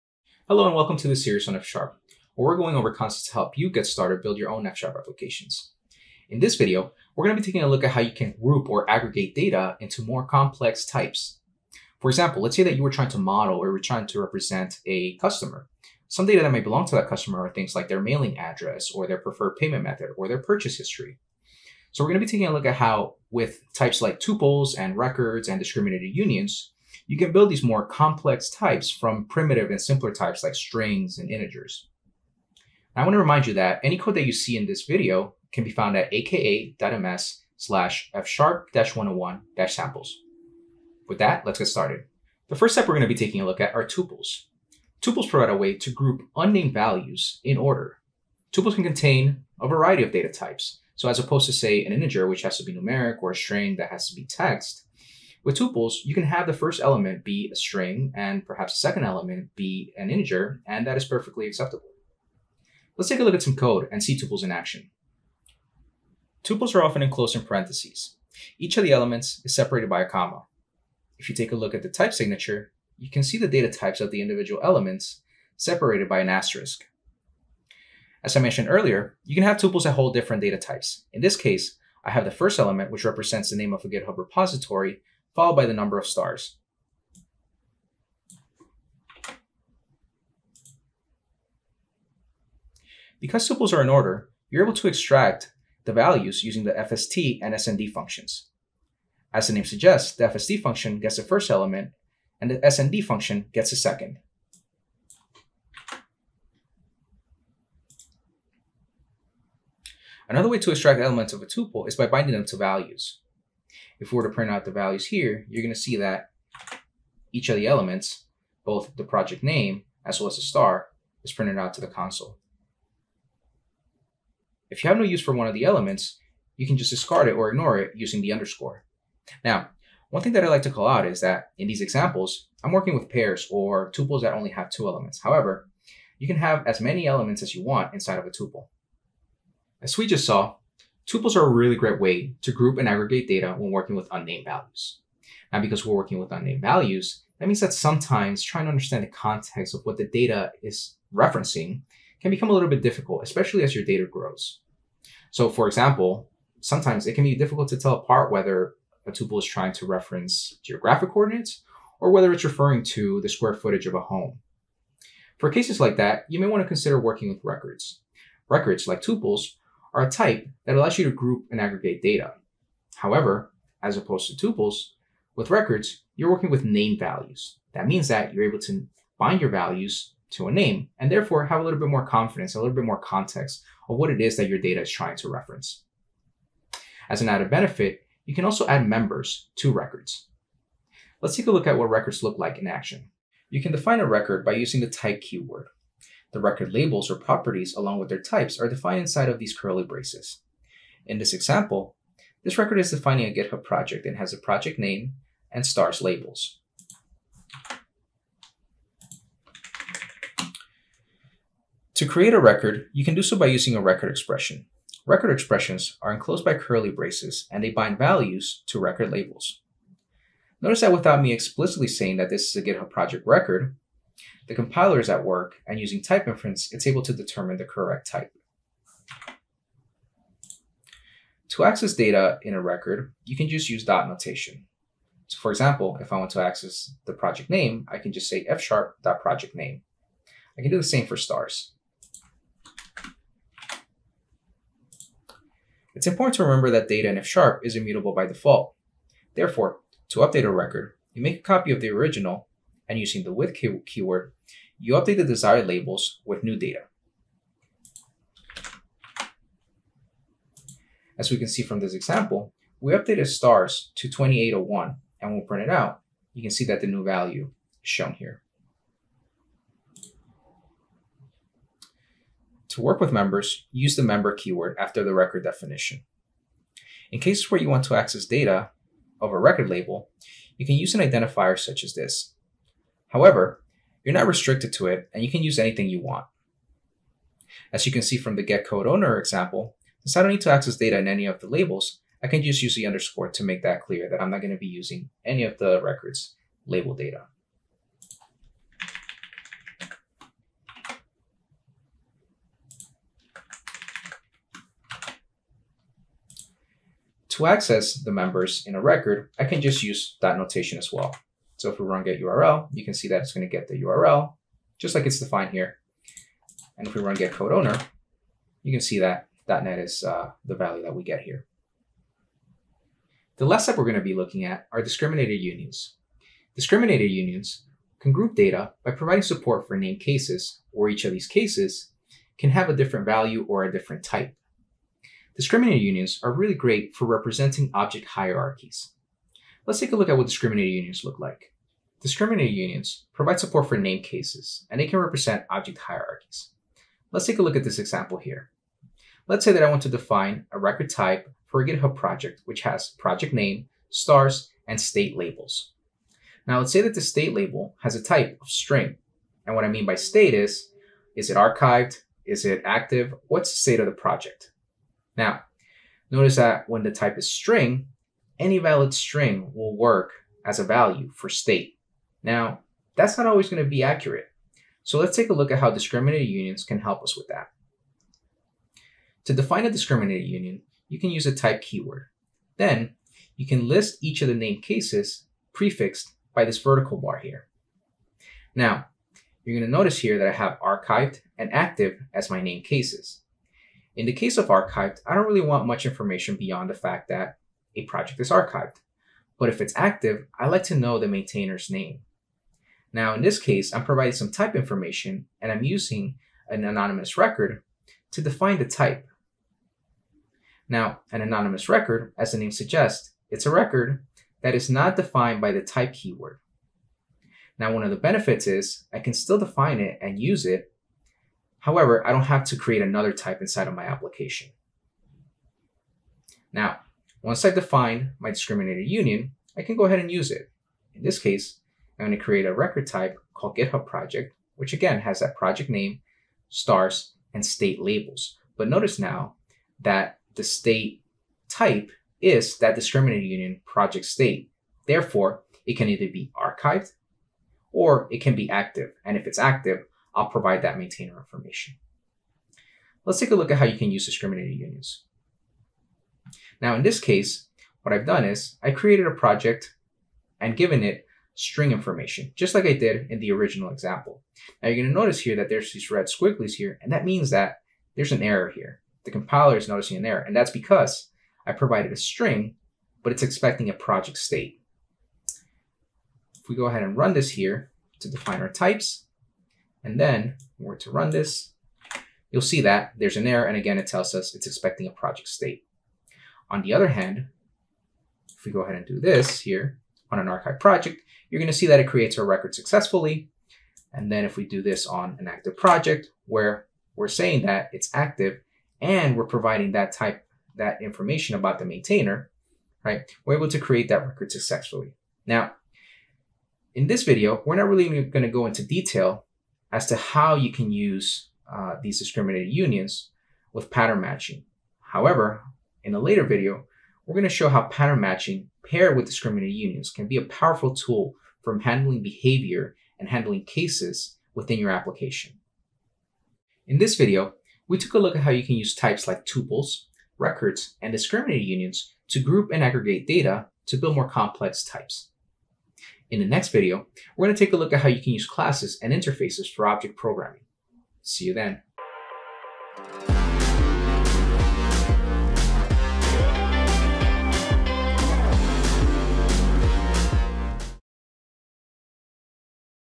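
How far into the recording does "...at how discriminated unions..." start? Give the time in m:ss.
6:15.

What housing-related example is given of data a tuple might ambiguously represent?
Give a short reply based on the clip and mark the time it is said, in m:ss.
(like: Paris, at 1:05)
Square footage of a home, at 2:43.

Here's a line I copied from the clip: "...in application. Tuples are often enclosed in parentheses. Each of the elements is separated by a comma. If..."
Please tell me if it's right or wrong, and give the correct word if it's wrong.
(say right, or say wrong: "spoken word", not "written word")
wrong: "action", not "application".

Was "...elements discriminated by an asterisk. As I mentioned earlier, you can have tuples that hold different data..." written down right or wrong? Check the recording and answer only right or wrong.
wrong.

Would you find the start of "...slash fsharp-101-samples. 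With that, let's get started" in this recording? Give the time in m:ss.
0:37.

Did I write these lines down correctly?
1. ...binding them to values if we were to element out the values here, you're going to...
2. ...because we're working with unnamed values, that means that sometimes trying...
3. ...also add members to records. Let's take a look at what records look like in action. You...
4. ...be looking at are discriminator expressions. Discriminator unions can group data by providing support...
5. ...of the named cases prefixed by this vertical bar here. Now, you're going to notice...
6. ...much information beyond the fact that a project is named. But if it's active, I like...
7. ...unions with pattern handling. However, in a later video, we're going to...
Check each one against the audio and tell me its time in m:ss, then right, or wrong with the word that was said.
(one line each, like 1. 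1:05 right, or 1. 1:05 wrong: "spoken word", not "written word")
1. 1:52 wrong: "print", not "element"
2. 2:25 right
3. 3:08 right
4. 5:24 wrong: "unions", not "expressions"
5. 6:24 right
6. 6:35 wrong: "archived", not "named"
7. 8:32 wrong: "matching", not "handling".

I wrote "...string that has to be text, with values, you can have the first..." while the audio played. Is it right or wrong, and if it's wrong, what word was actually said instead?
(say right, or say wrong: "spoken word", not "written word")
wrong: "tuples", not "values".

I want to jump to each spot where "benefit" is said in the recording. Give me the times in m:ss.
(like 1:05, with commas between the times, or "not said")
3:07, 6:57.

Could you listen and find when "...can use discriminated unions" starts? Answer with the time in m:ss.
7:33.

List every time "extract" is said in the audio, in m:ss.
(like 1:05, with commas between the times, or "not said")
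1:34, 1:50.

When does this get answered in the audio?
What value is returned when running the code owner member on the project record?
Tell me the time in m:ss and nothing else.
5:19.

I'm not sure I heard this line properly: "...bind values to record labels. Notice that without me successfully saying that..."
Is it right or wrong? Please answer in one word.
wrong.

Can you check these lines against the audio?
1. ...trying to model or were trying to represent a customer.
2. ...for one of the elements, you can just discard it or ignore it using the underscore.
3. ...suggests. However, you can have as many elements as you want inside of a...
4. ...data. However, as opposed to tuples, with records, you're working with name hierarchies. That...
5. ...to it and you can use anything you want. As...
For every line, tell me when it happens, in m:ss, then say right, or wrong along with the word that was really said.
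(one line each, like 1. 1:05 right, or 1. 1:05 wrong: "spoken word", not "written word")
1. 0:12 right
2. 2:05 right
3. 2:14 wrong: "elements", not "suggests"
4. 2:52 wrong: "values", not "hierarchies"
5. 4:44 right.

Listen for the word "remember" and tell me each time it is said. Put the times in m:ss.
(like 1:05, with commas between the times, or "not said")
4:06.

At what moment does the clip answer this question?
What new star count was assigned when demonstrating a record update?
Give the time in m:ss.
4:24.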